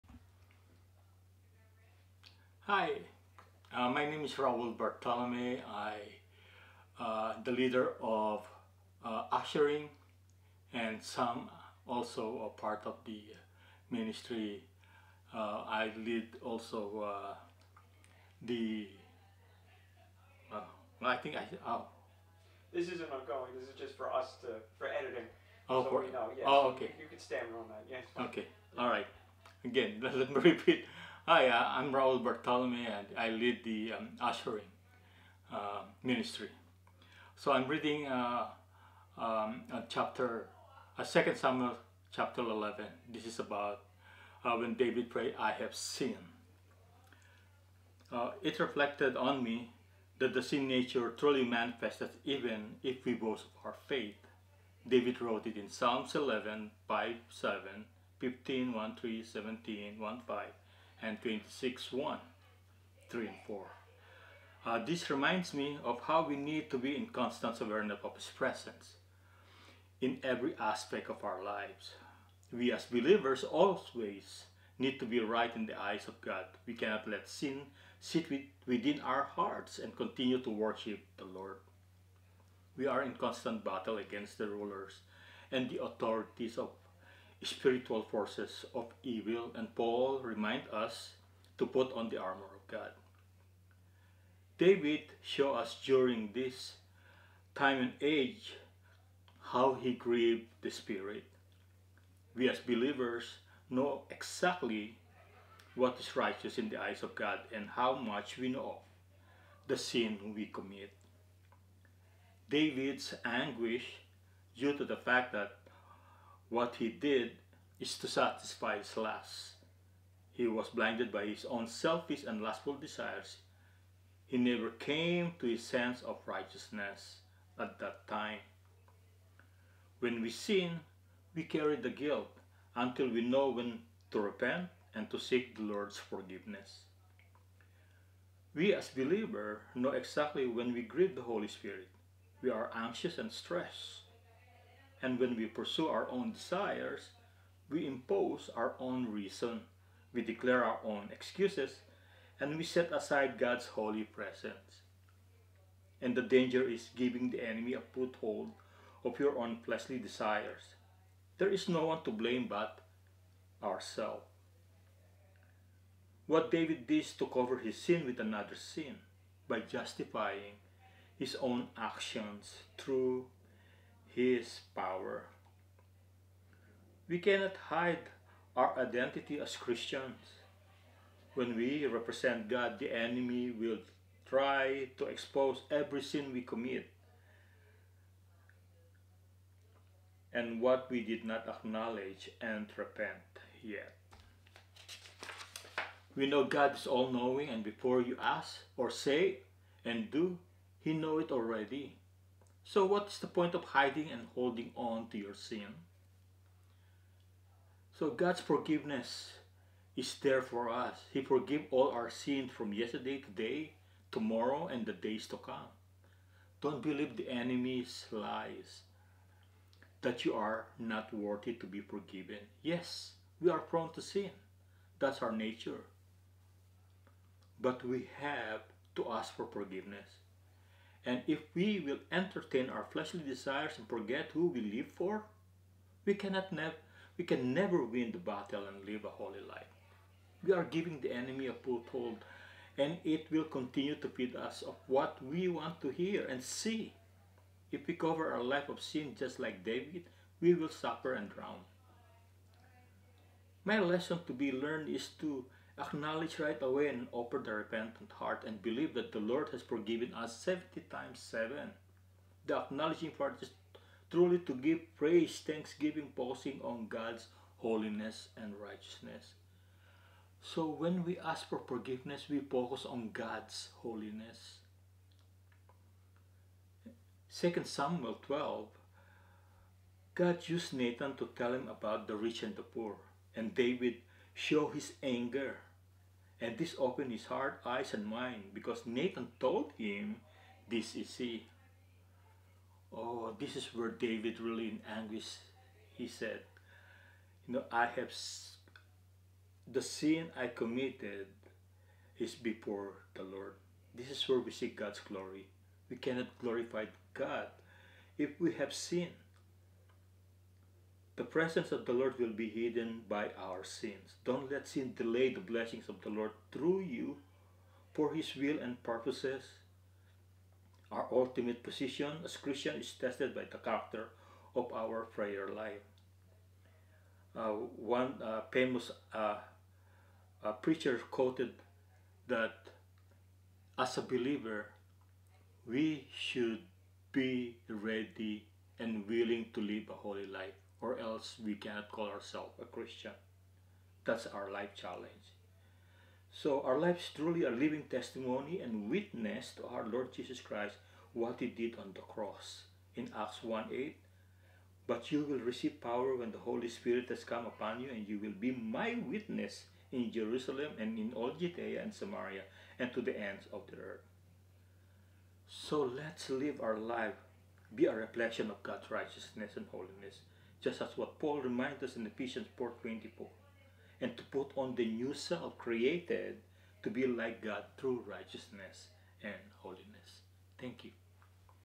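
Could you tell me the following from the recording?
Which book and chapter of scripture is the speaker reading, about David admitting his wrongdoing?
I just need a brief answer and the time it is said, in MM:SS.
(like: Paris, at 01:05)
2 Samuel 11, at 00:41.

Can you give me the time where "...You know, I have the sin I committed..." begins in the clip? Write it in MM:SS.
04:57.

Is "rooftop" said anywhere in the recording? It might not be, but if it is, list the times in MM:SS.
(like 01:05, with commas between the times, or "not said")
not said.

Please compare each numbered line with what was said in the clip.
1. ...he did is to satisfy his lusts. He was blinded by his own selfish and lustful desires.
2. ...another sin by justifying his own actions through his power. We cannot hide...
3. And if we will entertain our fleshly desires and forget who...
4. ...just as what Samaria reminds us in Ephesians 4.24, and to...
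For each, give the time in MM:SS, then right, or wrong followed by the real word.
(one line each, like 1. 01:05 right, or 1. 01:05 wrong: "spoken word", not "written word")
1. 01:56 right
2. 02:48 right
3. 03:51 right
4. 06:10 wrong: "Paul", not "Samaria".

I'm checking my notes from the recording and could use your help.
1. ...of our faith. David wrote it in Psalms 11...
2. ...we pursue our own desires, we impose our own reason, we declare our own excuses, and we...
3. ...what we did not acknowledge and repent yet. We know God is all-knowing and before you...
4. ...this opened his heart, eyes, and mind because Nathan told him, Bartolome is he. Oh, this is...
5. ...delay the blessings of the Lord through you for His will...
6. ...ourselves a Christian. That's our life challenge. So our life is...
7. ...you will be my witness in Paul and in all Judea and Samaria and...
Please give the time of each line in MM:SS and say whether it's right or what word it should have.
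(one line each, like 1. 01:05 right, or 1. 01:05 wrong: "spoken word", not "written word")
1. 00:53 right
2. 02:25 right
3. 03:10 right
4. 04:46 wrong: "This", not "Bartolome"
5. 05:14 right
6. 05:42 right
7. 05:58 wrong: "Jerusalem", not "Paul".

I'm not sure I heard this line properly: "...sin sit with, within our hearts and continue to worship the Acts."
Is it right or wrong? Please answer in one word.
wrong.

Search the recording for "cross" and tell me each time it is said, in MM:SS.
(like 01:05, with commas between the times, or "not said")
05:52.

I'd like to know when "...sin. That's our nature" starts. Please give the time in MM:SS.
03:44.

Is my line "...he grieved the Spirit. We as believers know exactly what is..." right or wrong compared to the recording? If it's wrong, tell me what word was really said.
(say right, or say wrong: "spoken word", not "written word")
right.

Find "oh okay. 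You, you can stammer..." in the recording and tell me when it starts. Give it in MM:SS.
00:26.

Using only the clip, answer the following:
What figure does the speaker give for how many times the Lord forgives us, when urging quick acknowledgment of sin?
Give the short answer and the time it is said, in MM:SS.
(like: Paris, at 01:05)
70 times 7, at 04:20.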